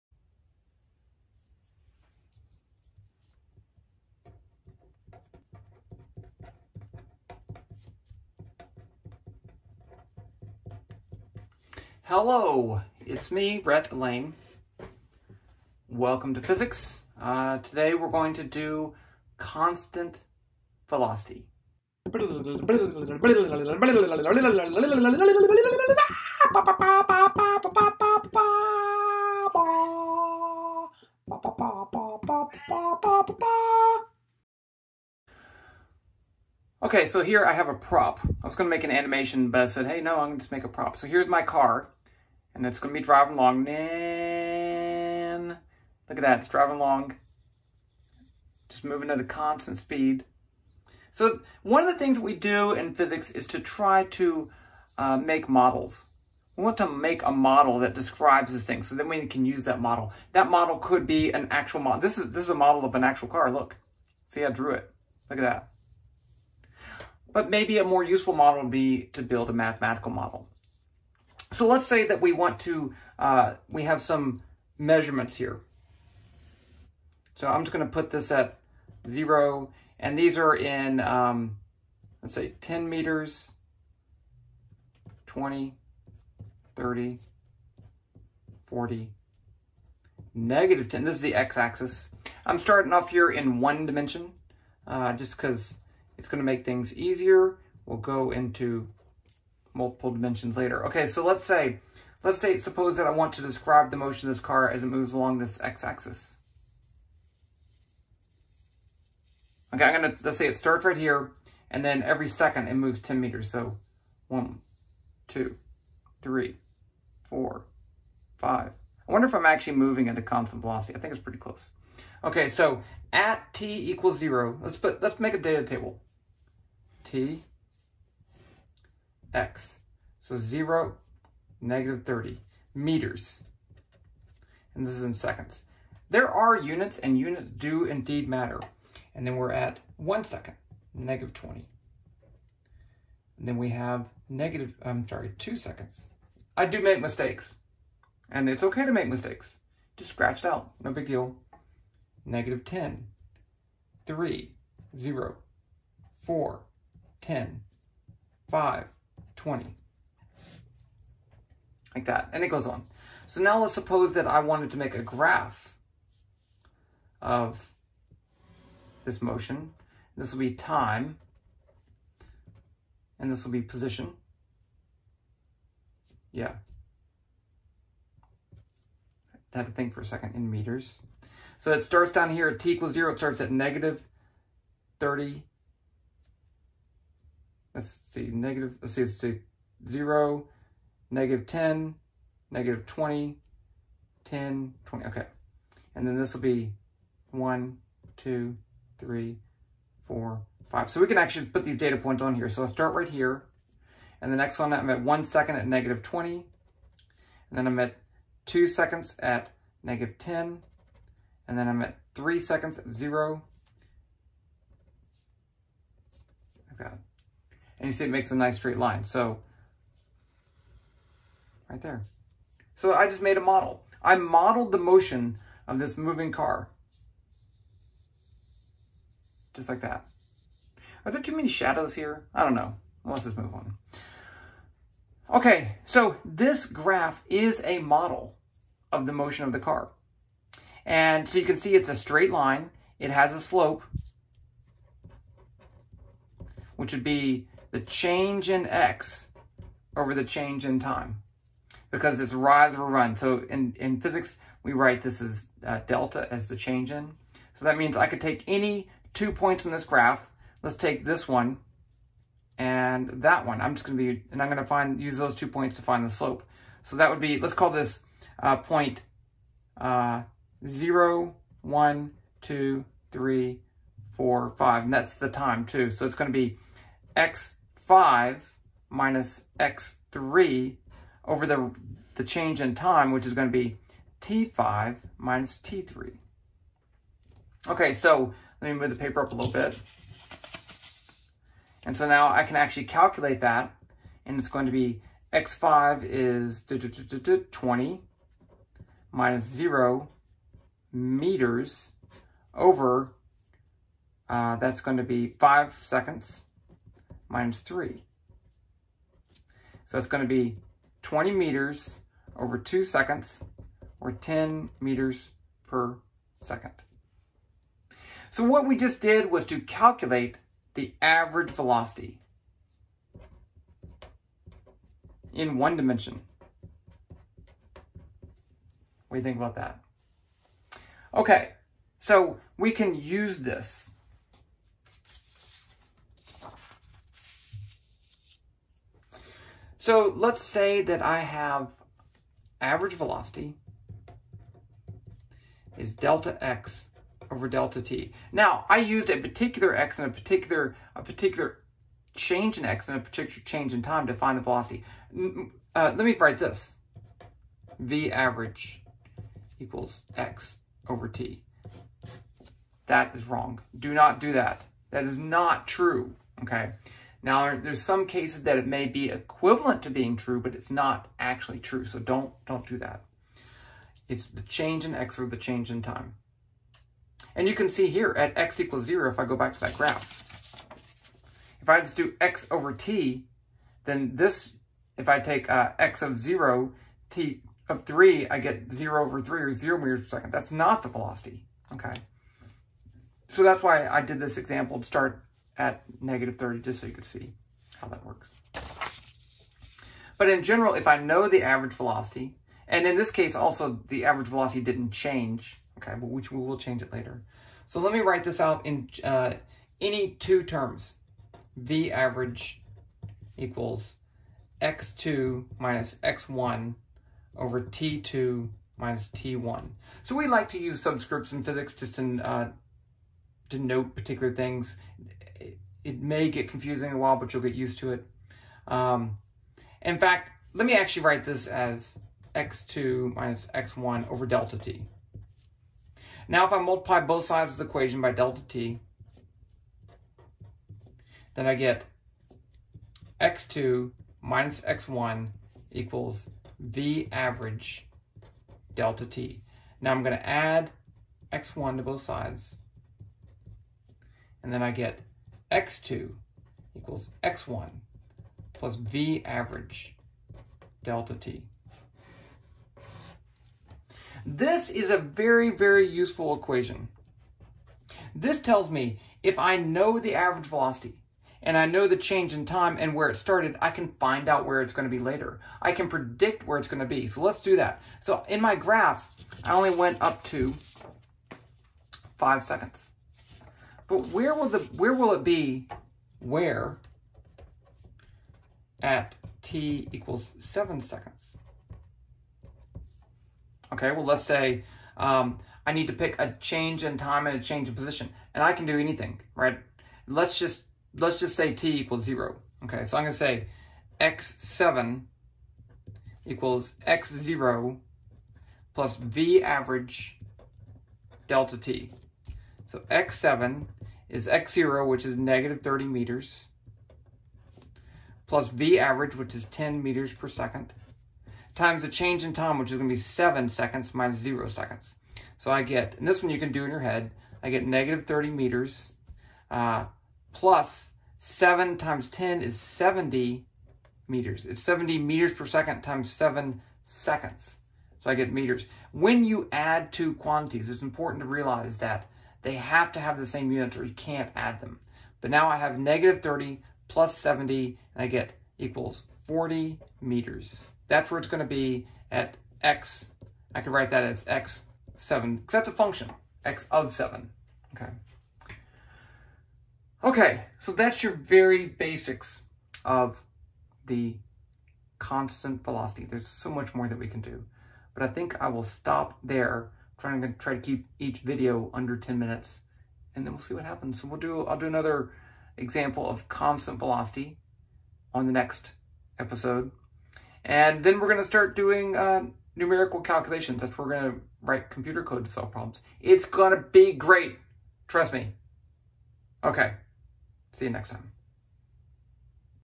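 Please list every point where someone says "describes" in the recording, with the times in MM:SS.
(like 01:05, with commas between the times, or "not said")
00:57, 01:43.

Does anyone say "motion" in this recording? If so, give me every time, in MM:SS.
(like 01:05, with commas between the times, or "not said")
01:43, 02:49, 03:44, 03:59.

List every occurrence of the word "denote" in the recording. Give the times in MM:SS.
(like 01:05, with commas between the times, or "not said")
07:03.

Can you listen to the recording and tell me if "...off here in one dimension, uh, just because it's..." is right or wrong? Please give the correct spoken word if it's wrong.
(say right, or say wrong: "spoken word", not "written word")
right.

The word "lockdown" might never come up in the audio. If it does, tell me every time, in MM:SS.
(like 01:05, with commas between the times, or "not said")
not said.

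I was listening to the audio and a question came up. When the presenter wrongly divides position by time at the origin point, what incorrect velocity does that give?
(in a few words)
0 meters per second.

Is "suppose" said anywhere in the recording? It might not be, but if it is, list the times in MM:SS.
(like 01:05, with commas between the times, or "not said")
01:42, 02:43.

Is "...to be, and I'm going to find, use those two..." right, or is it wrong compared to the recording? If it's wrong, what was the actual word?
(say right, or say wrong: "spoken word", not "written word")
right.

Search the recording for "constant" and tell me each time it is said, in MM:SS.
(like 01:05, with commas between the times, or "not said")
00:19, 00:49, 02:00, 09:24, 09:36.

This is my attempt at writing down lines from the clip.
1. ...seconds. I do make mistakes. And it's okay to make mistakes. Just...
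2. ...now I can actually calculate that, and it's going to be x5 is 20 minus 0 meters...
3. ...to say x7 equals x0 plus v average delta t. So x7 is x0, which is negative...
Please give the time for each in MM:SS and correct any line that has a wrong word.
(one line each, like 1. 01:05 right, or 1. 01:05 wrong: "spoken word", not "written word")
1. 02:25 right
2. 04:52 right
3. 08:23 right.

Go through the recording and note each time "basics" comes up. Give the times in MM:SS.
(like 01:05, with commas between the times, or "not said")
09:21.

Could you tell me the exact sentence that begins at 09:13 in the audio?
I could write that as x7, because that's a function, x of 7.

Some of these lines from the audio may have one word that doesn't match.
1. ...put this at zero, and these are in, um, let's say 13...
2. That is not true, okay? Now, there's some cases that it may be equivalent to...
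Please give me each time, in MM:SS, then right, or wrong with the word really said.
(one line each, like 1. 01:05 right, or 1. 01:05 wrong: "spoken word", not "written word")
1. 01:17 wrong: "10", not "13"
2. 06:04 right.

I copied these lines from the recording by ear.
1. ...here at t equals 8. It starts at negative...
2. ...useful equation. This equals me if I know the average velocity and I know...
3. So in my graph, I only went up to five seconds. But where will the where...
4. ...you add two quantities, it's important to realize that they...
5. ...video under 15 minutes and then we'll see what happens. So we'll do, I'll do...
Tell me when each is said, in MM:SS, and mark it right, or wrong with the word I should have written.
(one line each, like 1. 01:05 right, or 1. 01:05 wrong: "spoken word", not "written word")
1. 03:02 wrong: "0", not "8"
2. 07:45 wrong: "tells", not "equals"
3. 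07:57 right
4. 08:59 right
5. 09:31 wrong: "10", not "15".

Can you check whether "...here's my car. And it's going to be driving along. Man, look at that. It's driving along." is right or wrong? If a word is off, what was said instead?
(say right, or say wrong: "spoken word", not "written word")
right.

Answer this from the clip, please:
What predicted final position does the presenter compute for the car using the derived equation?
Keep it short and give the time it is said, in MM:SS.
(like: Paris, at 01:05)
40 meters, at 09:09.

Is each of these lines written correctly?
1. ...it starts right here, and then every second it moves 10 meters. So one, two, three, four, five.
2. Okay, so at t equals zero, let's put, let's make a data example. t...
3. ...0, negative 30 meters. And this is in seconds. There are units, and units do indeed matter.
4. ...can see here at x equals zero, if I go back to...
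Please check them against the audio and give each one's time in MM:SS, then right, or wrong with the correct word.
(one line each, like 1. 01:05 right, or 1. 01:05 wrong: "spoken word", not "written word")
1. 01:50 right
2. 02:02 wrong: "table", not "example"
3. 02:10 right
4. 06:17 right.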